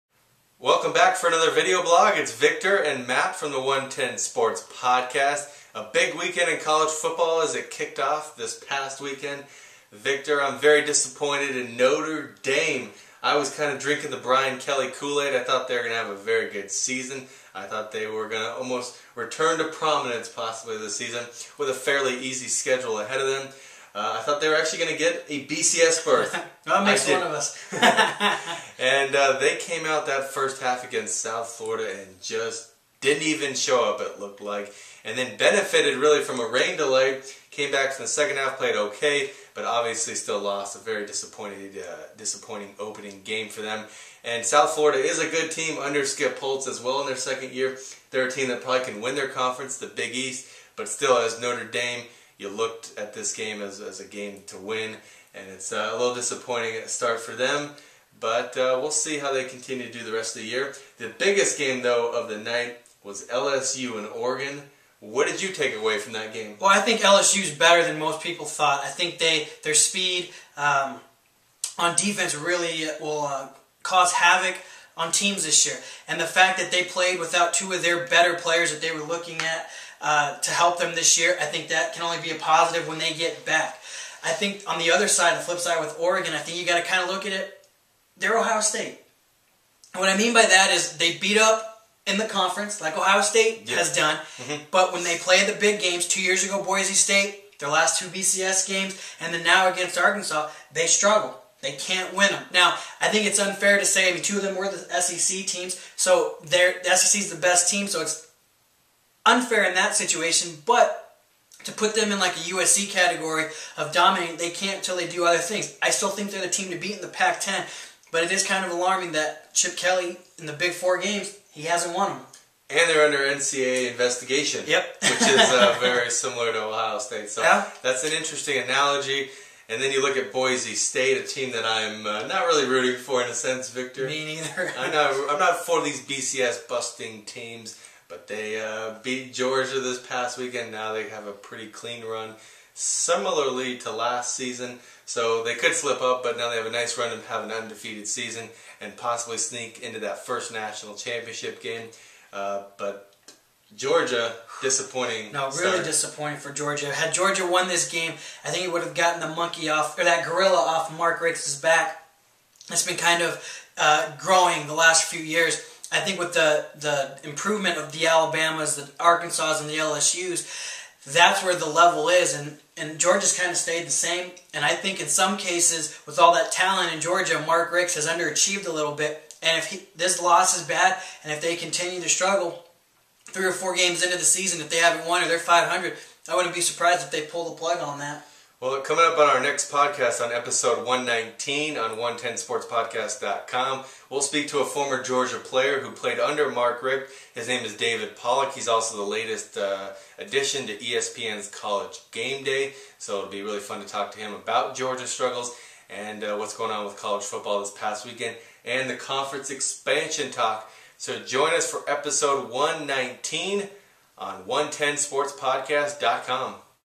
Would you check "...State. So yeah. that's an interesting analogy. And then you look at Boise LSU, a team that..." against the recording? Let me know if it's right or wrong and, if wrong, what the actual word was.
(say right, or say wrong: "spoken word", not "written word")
wrong: "State", not "LSU".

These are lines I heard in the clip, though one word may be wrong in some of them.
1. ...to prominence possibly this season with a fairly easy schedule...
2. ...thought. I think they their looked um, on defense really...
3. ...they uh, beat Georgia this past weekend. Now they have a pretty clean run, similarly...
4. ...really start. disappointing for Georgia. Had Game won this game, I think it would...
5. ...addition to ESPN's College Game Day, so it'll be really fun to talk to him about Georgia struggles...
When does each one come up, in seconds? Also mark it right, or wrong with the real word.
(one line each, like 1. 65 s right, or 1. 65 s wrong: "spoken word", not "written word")
1. 19 s right
2. 68 s wrong: "speed", not "looked"
3. 138 s right
4. 155 s wrong: "Georgia", not "Game"
5. 200 s right.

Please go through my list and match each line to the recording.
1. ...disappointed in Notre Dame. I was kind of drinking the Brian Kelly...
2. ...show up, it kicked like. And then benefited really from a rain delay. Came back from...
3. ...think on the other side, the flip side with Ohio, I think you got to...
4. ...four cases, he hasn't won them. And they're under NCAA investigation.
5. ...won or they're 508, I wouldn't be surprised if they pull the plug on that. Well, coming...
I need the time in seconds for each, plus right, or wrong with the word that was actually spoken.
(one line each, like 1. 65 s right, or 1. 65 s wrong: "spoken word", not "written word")
1. 10 s right
2. 33 s wrong: "looked", not "kicked"
3. 84 s wrong: "Oregon", not "Ohio"
4. 120 s wrong: "games", not "cases"
5. 185 s wrong: "500", not "508".